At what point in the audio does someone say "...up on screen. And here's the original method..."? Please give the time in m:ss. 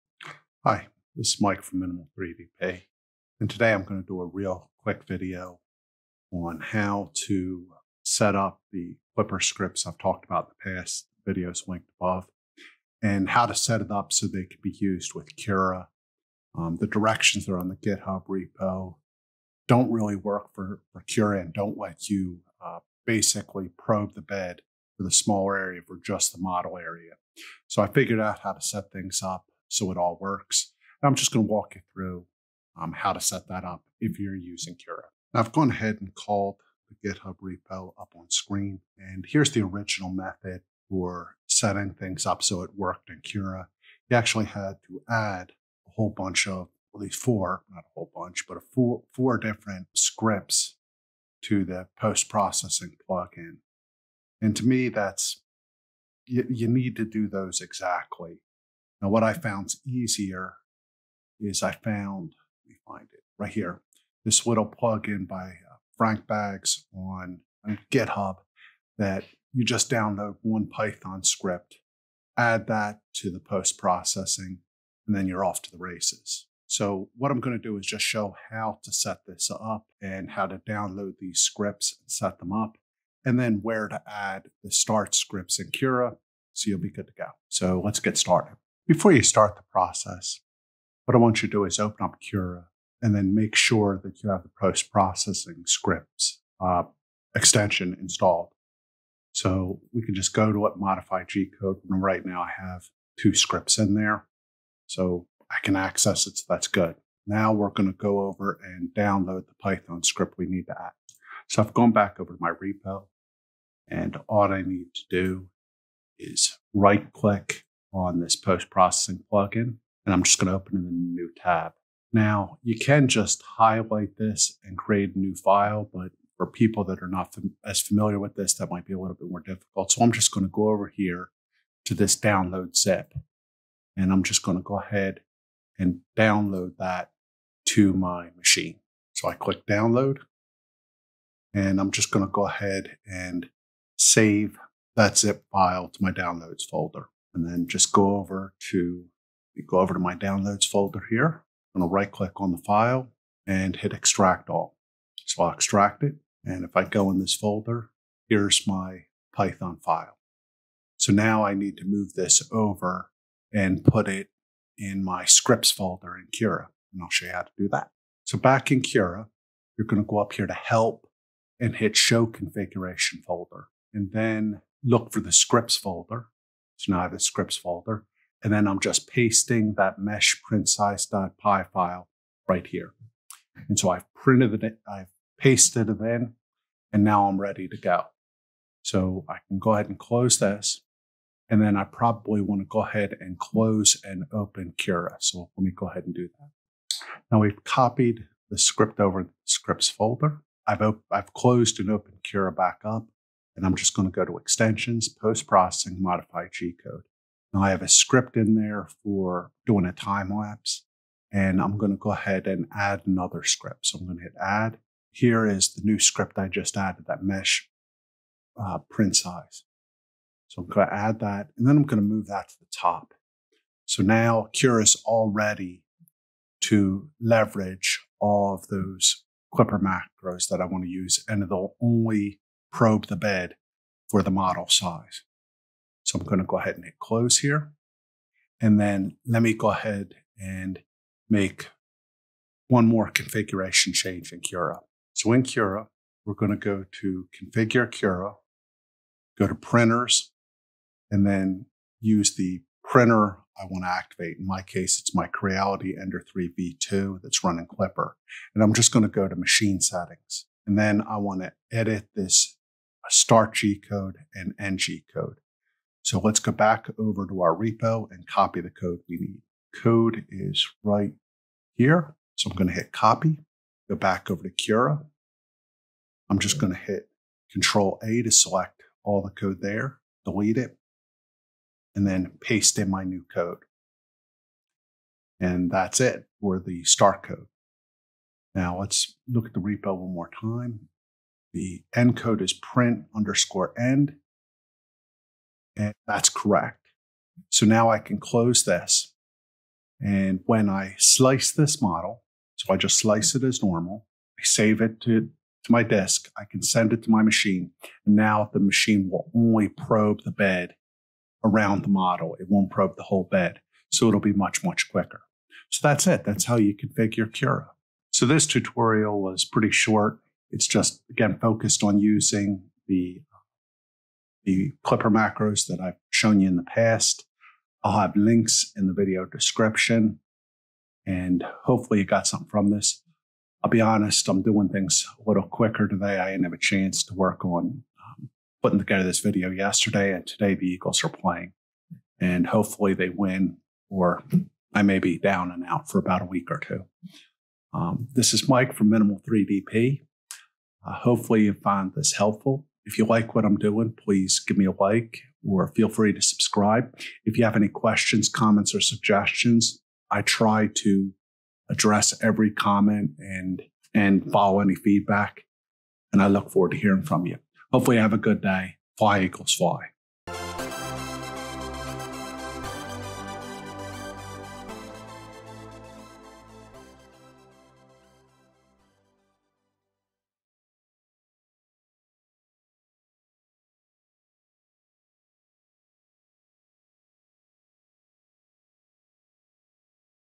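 0:37.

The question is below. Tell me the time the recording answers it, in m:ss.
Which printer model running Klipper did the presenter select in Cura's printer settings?
4:15.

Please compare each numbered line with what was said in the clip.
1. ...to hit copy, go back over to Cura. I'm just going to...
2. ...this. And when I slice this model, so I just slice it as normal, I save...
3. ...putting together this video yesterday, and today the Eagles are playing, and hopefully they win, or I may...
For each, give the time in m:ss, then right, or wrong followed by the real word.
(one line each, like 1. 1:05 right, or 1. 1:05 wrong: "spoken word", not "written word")
1. 4:32 right
2. 4:58 right
3. 5:38 right.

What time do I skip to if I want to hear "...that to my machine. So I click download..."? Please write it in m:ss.
2:16.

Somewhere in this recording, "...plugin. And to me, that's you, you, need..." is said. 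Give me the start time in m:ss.
0:53.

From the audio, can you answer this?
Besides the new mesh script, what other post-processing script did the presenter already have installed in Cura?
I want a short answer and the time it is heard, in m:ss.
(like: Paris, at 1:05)
Time lapse, at 3:29.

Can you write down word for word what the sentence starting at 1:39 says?
So we can just go to what modify G code.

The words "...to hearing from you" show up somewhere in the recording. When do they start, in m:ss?
6:06.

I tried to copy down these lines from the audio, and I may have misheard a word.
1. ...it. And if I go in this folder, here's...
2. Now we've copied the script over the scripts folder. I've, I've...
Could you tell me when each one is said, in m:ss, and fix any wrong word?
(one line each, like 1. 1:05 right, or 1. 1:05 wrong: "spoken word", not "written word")
1. 2:36 right
2. 3:17 right.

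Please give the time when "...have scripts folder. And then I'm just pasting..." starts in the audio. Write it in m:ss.
2:57.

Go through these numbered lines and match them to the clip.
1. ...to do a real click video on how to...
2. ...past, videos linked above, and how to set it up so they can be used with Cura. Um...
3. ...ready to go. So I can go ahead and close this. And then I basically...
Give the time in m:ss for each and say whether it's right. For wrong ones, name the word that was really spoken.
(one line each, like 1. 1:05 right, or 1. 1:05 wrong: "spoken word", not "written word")
1. 0:03 wrong: "quick", not "click"
2. 0:10 right
3. 3:07 wrong: "probably", not "basically".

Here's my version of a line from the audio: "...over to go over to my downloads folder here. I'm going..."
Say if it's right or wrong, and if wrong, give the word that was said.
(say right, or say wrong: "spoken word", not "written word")
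right.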